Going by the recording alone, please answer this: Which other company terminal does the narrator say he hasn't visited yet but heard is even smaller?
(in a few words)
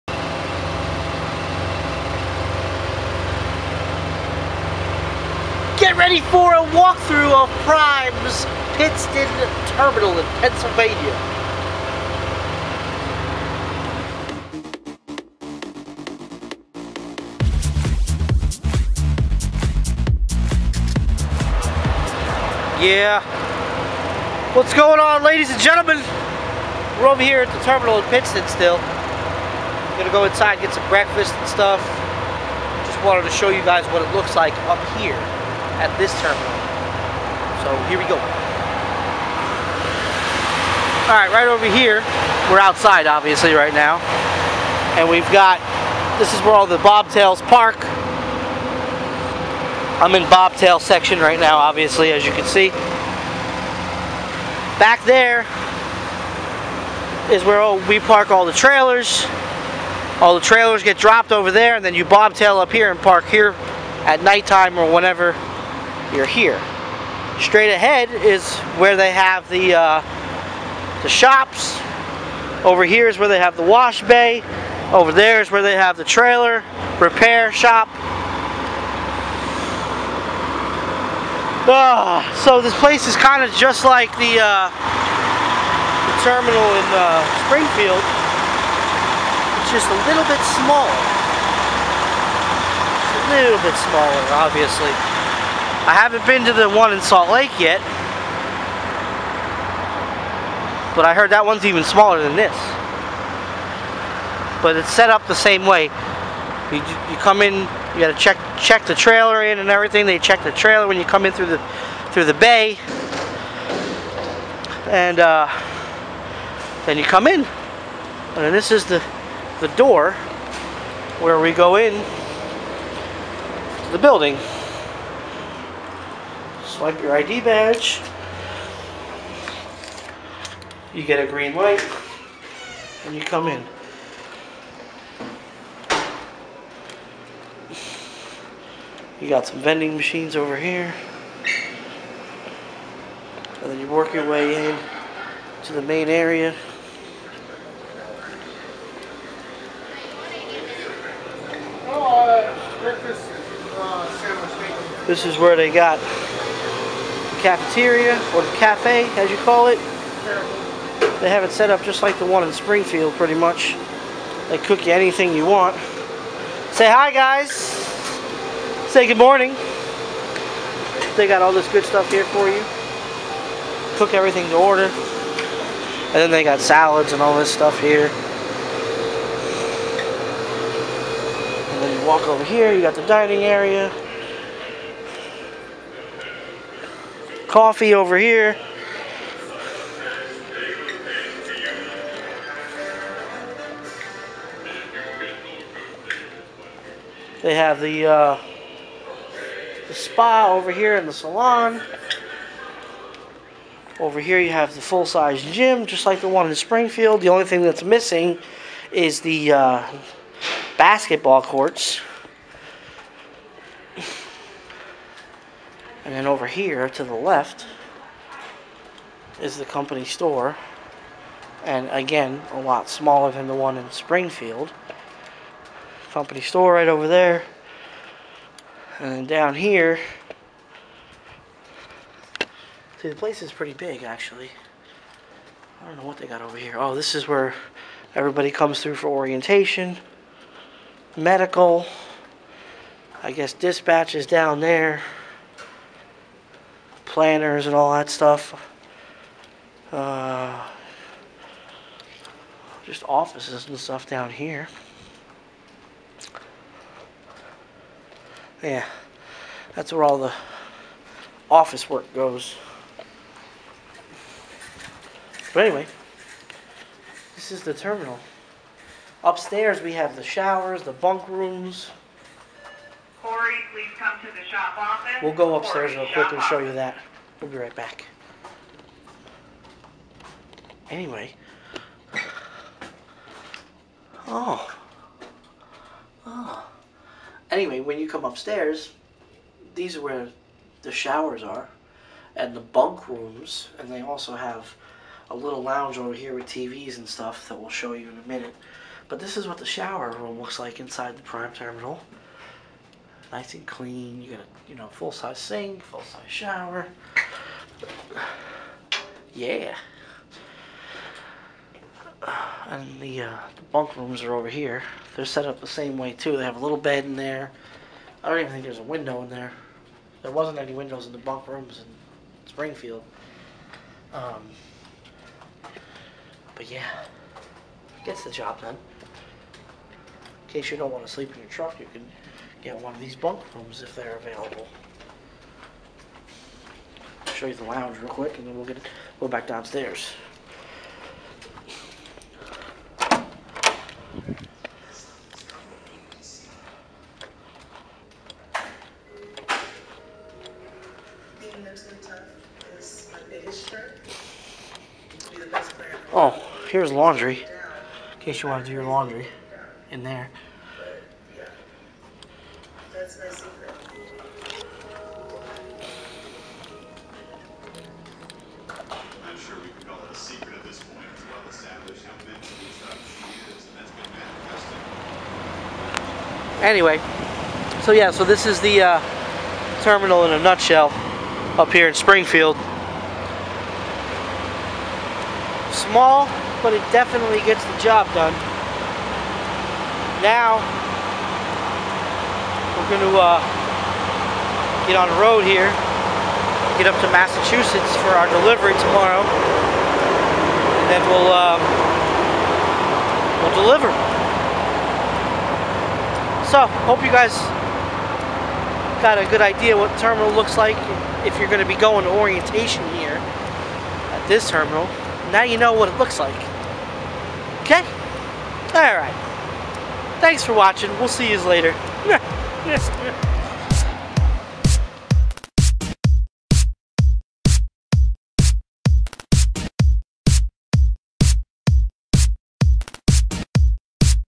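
Salt Lake.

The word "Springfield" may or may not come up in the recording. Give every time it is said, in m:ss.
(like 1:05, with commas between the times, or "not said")
1:27, 2:42, 3:26, 3:43, 5:22, 6:21.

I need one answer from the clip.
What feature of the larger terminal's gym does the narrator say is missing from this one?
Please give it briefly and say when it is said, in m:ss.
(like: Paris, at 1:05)
Basketball courts, at 3:30.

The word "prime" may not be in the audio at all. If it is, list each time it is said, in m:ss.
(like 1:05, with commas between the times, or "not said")
0:07, 5:01.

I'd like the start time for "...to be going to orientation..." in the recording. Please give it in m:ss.
6:51.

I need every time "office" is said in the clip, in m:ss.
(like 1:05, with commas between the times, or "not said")
4:13, 4:21, 4:34.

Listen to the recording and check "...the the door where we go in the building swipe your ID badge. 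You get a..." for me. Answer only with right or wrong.
right.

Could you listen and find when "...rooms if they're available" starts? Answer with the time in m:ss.
5:33.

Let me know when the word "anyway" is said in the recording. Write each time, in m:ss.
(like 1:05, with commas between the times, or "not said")
4:25, 4:40, 4:47, 6:16.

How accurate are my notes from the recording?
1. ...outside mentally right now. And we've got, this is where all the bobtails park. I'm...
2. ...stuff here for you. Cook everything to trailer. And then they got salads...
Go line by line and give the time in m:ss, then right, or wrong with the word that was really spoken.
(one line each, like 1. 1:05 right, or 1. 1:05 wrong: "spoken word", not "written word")
1. 0:42 wrong: "obviously", not "mentally"
2. 2:51 wrong: "order", not "trailer".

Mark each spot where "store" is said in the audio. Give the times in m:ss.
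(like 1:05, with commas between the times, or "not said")
3:40, 3:46.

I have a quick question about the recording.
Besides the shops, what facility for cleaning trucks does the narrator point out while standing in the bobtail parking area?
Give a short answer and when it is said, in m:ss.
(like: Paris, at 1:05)
Wash bay, at 1:13.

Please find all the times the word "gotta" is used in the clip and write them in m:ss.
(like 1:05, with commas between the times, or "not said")
1:47.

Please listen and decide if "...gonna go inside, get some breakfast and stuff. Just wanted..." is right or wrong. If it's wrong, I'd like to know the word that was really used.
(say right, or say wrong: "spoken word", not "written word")
right.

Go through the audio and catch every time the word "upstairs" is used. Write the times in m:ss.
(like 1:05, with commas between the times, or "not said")
4:29, 4:35, 4:48.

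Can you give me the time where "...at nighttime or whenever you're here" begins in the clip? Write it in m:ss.
1:04.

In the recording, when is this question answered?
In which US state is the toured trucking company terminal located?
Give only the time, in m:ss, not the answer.
0:10.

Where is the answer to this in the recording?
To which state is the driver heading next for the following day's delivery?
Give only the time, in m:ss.
6:37.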